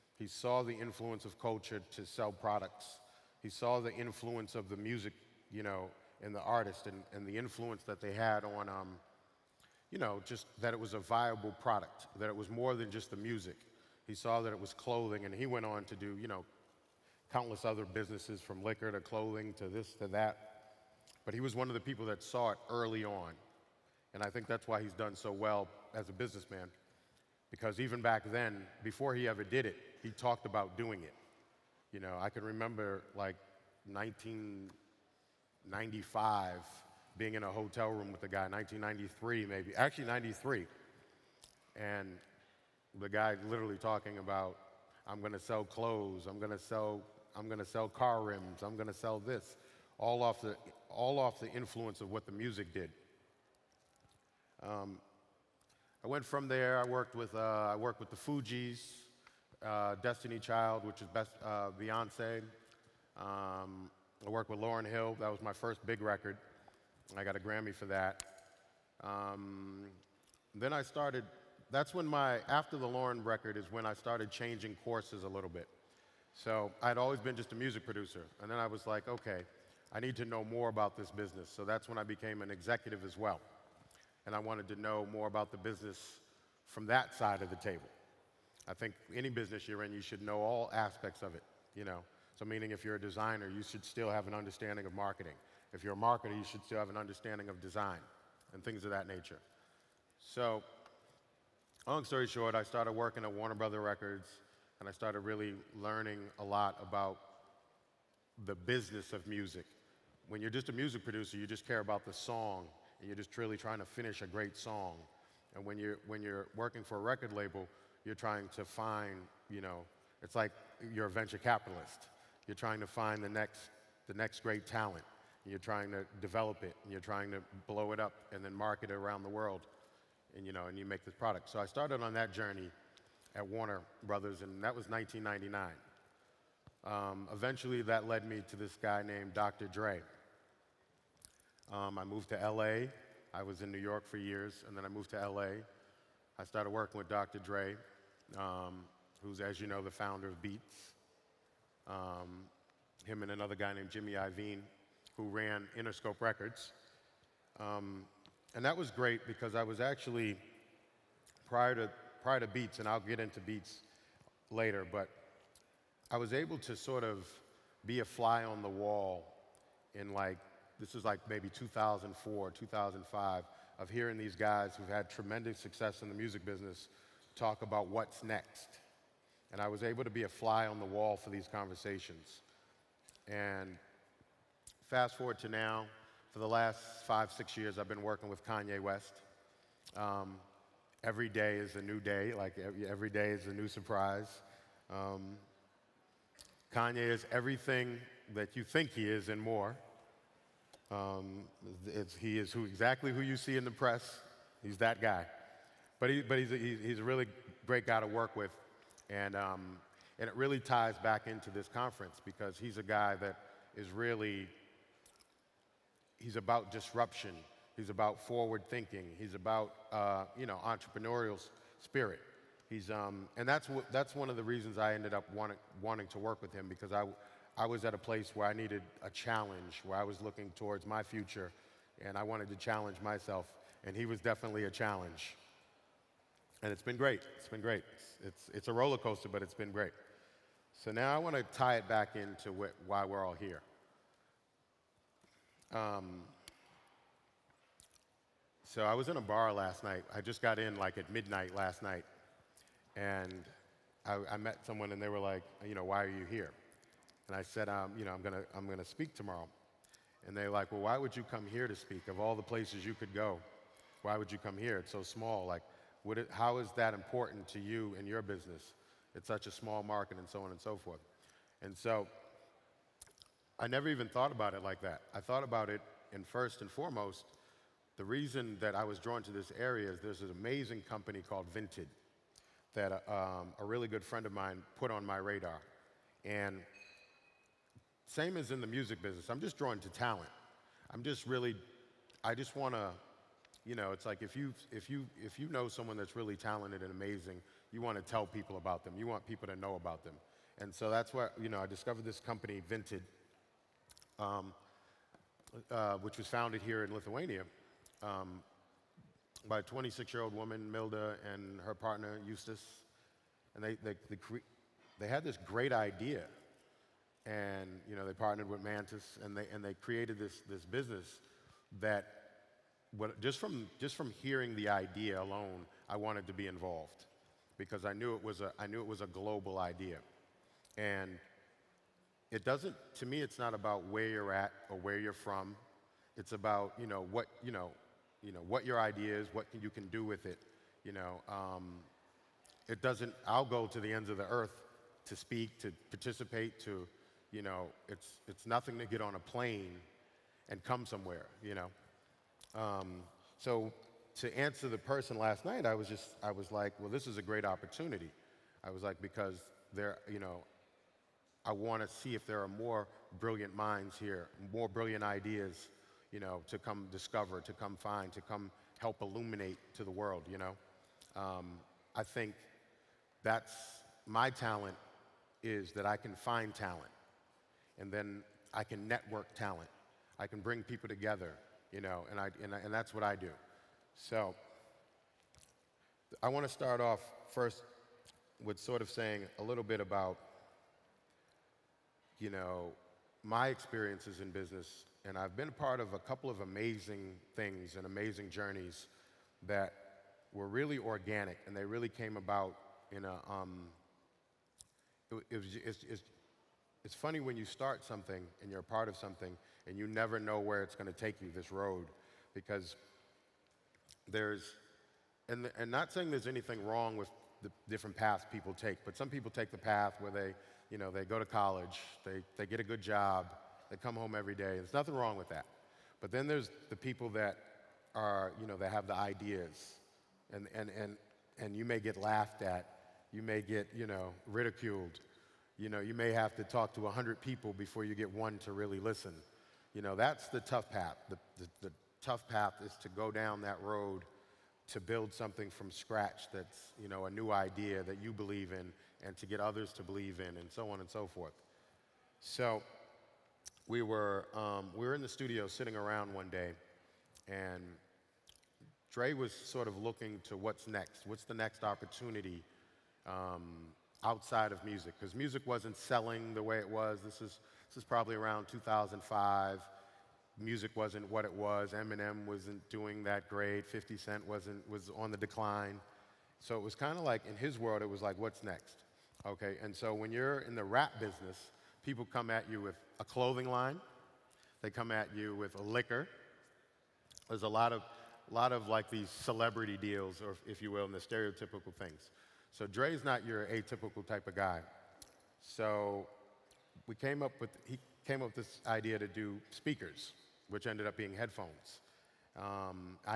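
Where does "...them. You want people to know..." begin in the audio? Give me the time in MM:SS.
04:58.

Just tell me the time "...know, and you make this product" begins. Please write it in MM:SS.
02:10.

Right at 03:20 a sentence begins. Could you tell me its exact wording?
Um, he is who, exactly who you see in the press.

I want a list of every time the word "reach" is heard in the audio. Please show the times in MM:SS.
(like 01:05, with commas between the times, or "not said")
not said.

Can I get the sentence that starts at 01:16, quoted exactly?
So I'd always been just a music producer.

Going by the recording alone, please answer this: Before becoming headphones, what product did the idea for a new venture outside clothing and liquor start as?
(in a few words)
speakers.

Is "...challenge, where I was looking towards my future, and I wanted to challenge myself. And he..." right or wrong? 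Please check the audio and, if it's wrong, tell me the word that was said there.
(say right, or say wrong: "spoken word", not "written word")
right.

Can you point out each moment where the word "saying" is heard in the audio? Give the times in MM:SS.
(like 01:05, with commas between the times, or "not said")
06:28, 06:55.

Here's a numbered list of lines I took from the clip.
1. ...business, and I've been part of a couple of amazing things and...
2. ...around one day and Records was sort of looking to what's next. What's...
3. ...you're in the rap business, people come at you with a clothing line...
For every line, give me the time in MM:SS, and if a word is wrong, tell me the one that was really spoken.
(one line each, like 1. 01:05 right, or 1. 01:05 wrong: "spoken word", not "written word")
1. 06:34 right
2. 07:35 wrong: "Dre", not "Records"
3. 08:00 right.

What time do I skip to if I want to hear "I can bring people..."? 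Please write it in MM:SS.
06:20.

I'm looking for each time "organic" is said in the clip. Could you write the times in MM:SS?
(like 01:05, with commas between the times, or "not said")
06:40.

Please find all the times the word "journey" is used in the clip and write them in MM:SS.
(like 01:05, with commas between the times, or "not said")
02:12, 06:38.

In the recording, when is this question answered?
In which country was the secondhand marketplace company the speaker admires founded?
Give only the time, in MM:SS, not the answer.
05:06.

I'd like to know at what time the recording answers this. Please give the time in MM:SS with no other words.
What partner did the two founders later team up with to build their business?
05:18.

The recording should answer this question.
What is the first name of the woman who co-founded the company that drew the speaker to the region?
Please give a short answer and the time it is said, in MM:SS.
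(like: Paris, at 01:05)
Milda, at 05:10.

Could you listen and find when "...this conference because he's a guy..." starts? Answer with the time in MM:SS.
03:31.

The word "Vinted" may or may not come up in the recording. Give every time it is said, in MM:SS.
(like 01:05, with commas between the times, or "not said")
04:41, 05:02.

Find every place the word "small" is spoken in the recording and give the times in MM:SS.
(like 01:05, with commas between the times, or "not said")
04:25, 04:29.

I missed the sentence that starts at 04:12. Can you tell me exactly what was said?
And I, I met someone, and they were like, you know, why are you here?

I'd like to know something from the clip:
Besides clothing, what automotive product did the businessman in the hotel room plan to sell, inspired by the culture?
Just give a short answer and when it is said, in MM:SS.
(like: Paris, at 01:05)
car rims, at 00:47.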